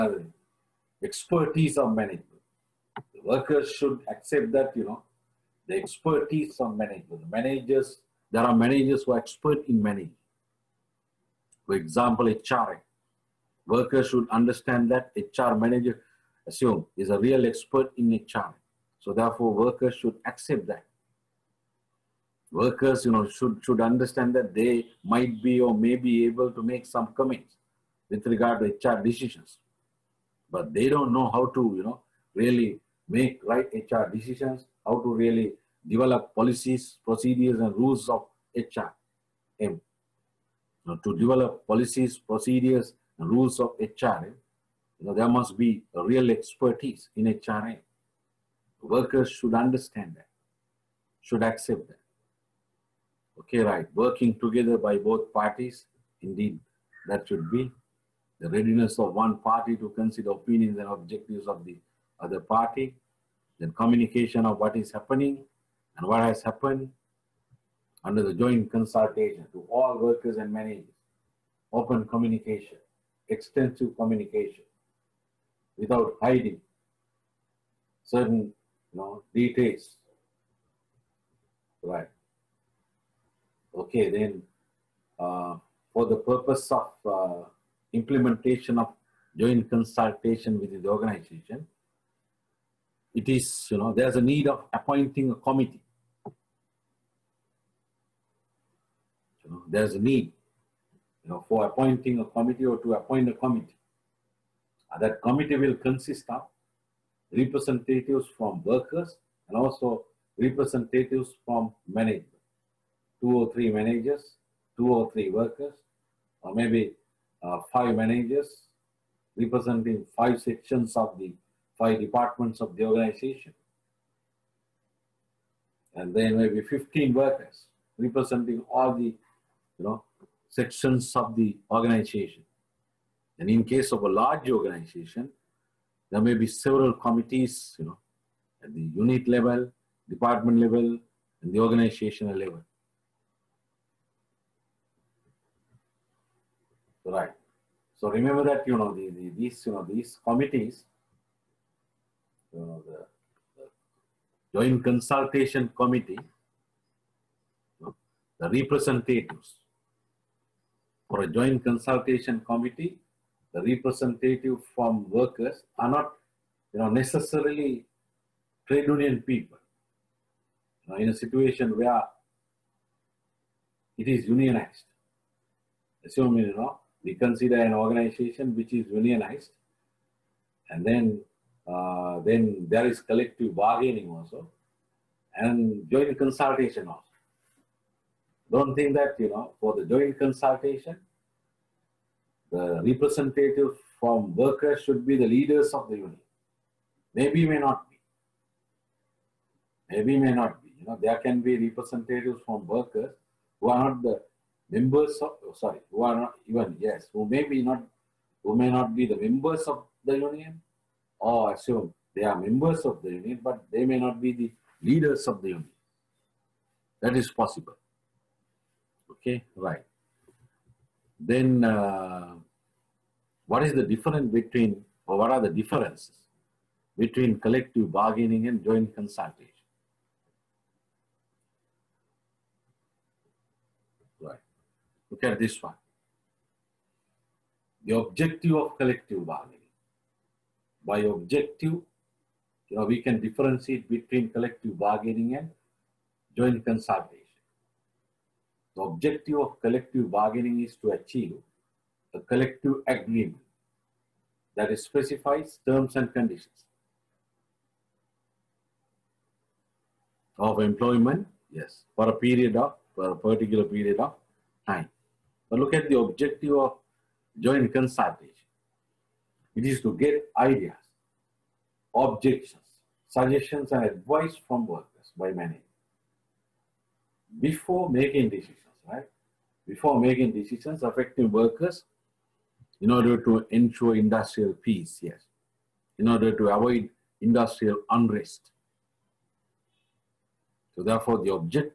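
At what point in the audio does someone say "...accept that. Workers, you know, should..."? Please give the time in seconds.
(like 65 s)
20 s.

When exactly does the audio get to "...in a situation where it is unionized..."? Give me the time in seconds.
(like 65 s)
170 s.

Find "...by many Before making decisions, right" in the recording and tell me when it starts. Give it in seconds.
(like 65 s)
275 s.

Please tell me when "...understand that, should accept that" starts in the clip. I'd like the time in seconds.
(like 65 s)
49 s.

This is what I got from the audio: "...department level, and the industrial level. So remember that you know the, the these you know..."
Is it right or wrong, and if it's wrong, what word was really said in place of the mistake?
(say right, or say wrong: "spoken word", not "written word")
wrong: "organizational", not "industrial".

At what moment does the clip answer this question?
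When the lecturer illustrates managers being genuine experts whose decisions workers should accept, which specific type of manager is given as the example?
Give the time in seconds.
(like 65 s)
15 s.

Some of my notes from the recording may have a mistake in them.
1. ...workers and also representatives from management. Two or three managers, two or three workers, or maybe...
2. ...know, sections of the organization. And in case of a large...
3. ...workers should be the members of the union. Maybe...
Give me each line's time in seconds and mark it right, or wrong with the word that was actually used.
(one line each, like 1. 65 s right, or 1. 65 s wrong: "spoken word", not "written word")
1. 108 s right
2. 129 s right
3. 194 s wrong: "leaders", not "members".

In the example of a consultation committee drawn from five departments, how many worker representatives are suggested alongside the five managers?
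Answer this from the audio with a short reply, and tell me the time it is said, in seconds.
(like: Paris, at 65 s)
15, at 126 s.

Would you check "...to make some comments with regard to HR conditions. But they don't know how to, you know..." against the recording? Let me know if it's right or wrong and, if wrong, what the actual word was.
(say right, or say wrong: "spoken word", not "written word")
wrong: "decisions", not "conditions".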